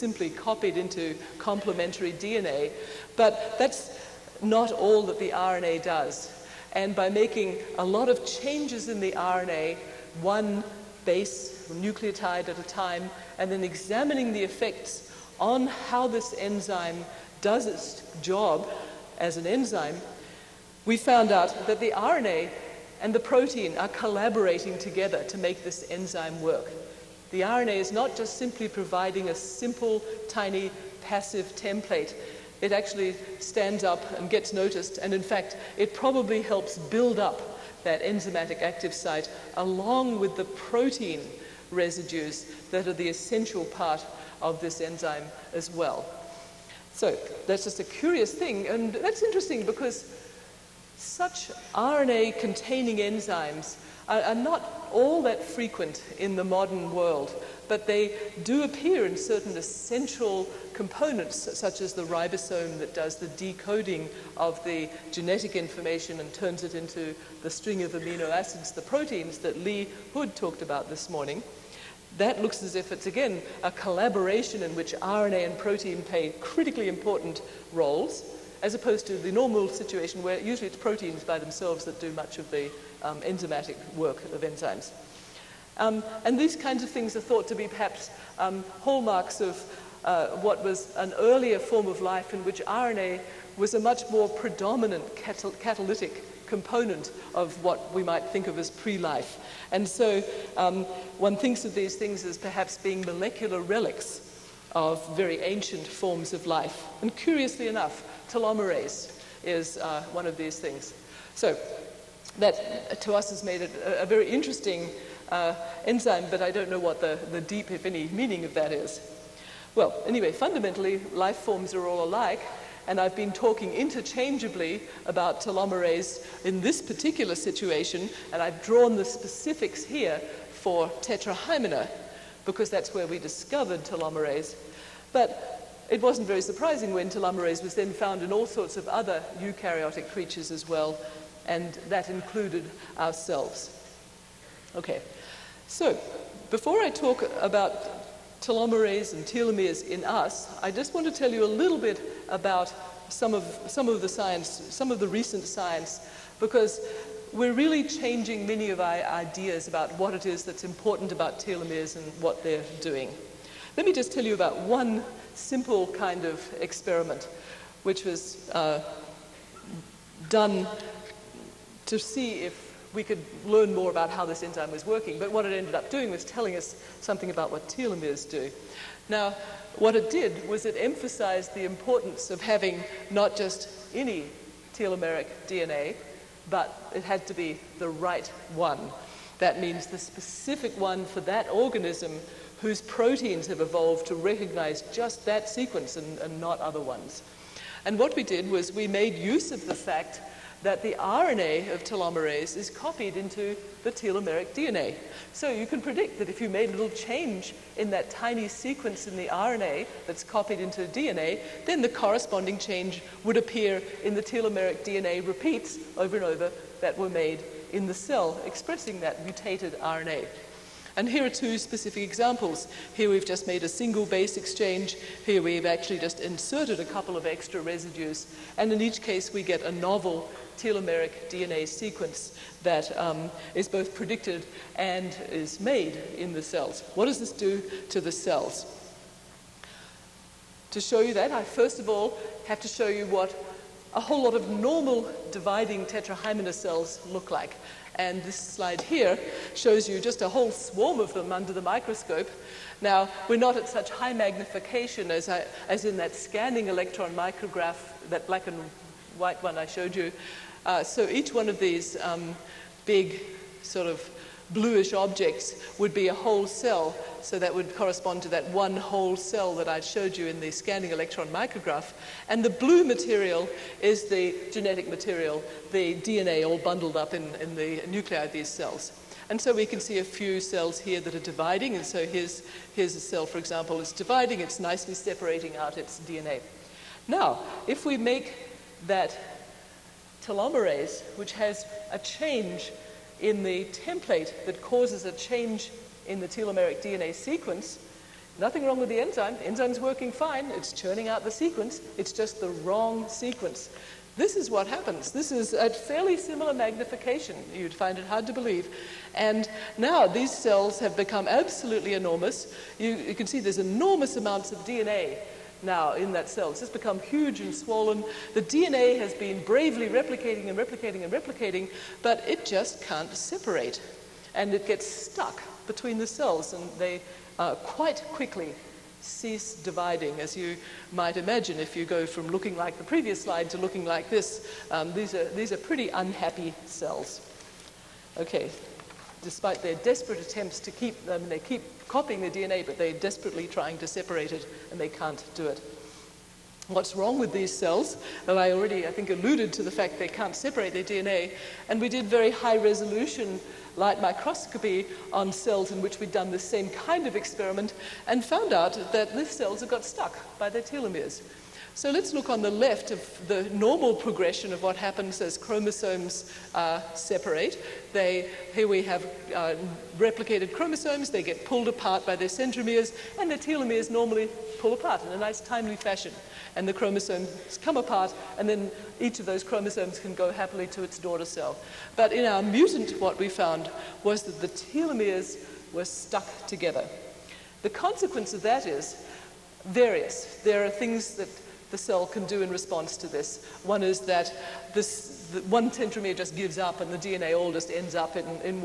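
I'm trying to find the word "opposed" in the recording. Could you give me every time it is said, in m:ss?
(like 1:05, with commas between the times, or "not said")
1:18.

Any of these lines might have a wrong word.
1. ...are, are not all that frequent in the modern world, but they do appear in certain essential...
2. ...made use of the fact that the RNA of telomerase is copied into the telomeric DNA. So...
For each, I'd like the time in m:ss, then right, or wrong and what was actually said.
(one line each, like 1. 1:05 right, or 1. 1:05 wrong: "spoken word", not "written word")
1. 0:54 right
2. 3:18 right.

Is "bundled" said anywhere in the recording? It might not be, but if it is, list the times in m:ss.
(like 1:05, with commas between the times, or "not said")
4:36.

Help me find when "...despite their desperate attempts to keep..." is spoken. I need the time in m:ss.
5:39.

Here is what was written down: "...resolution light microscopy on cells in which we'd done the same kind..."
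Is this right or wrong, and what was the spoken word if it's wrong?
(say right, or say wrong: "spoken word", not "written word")
right.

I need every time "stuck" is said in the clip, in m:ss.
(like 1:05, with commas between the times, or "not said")
5:24, 5:59, 6:25.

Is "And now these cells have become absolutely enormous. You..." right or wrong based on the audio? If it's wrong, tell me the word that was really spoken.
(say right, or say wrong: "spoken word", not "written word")
right.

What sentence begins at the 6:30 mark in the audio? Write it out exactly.
There are things that the cell can do in response to this.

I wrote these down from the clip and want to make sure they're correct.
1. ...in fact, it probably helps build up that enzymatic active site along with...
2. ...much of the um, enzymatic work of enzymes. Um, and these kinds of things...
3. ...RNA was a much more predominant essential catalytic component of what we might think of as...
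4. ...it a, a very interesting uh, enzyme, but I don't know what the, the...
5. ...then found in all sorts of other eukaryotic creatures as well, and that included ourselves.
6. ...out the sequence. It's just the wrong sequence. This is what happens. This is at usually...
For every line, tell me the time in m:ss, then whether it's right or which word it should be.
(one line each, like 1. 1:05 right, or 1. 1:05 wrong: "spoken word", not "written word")
1. 0:35 right
2. 1:22 right
3. 1:32 wrong: "catal", not "essential"
4. 1:53 right
5. 2:17 right
6. 5:01 wrong: "fairly", not "usually".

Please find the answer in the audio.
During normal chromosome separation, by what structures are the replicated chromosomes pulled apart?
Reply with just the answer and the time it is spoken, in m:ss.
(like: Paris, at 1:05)
Centromeres, at 6:12.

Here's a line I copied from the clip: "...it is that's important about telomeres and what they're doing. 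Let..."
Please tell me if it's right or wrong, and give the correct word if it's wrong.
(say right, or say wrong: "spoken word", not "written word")
right.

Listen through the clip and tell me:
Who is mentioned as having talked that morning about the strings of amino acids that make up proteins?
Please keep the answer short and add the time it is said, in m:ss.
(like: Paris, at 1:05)
Lee Hood, at 1:09.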